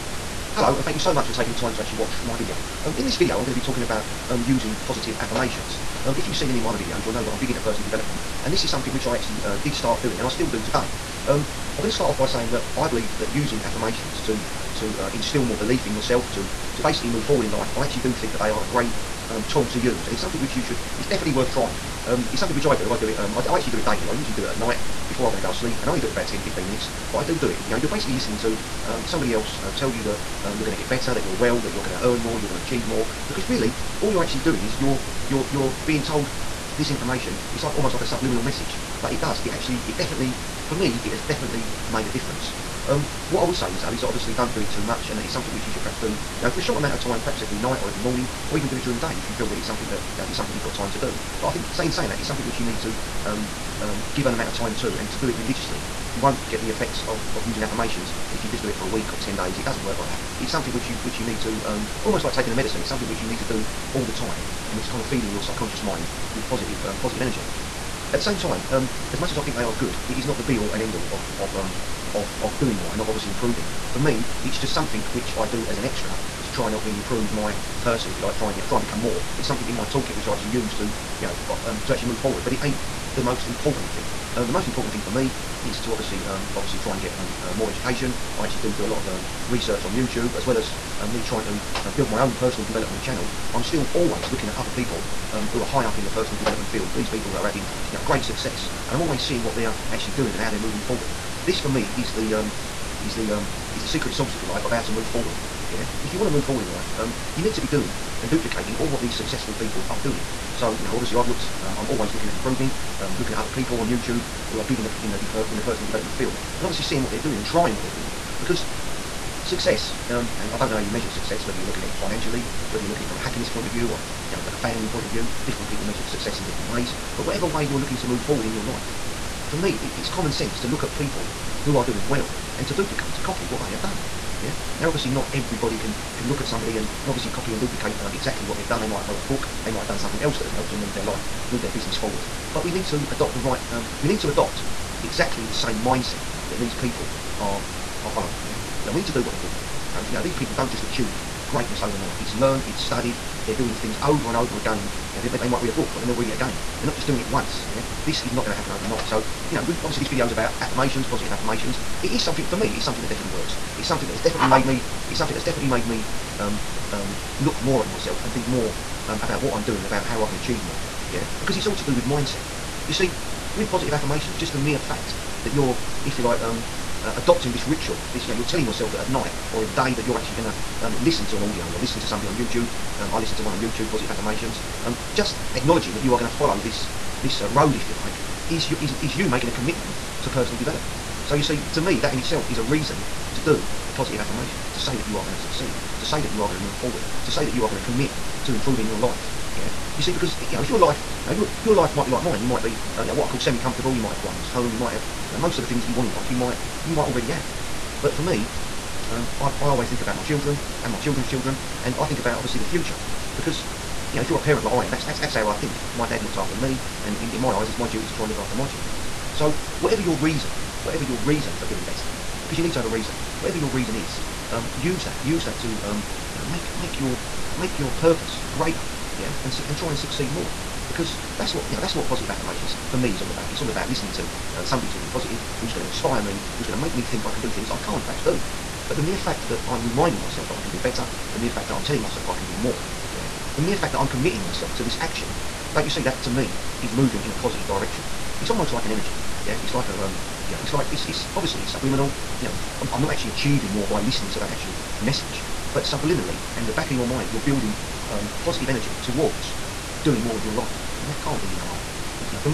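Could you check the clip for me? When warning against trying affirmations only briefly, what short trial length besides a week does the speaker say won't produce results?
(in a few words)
10 days.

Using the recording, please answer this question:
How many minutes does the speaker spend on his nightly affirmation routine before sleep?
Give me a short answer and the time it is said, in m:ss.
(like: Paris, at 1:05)
10, 15 minutes, at 0:26.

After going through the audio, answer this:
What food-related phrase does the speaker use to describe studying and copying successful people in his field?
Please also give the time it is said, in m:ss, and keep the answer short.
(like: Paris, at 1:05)
secret sauce, at 1:43.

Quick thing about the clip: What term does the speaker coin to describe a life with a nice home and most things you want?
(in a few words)
semi-comfortable.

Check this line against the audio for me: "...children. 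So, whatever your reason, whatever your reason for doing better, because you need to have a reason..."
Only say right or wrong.
right.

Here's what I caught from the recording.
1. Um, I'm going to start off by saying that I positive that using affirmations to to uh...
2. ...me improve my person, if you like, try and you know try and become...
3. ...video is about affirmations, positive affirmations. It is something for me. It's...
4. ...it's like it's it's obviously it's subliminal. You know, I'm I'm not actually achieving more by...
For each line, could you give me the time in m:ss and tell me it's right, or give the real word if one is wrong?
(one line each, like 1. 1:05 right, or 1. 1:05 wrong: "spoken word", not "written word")
1. 0:11 wrong: "believe", not "positive"
2. 1:16 right
3. 2:40 right
4. 4:10 right.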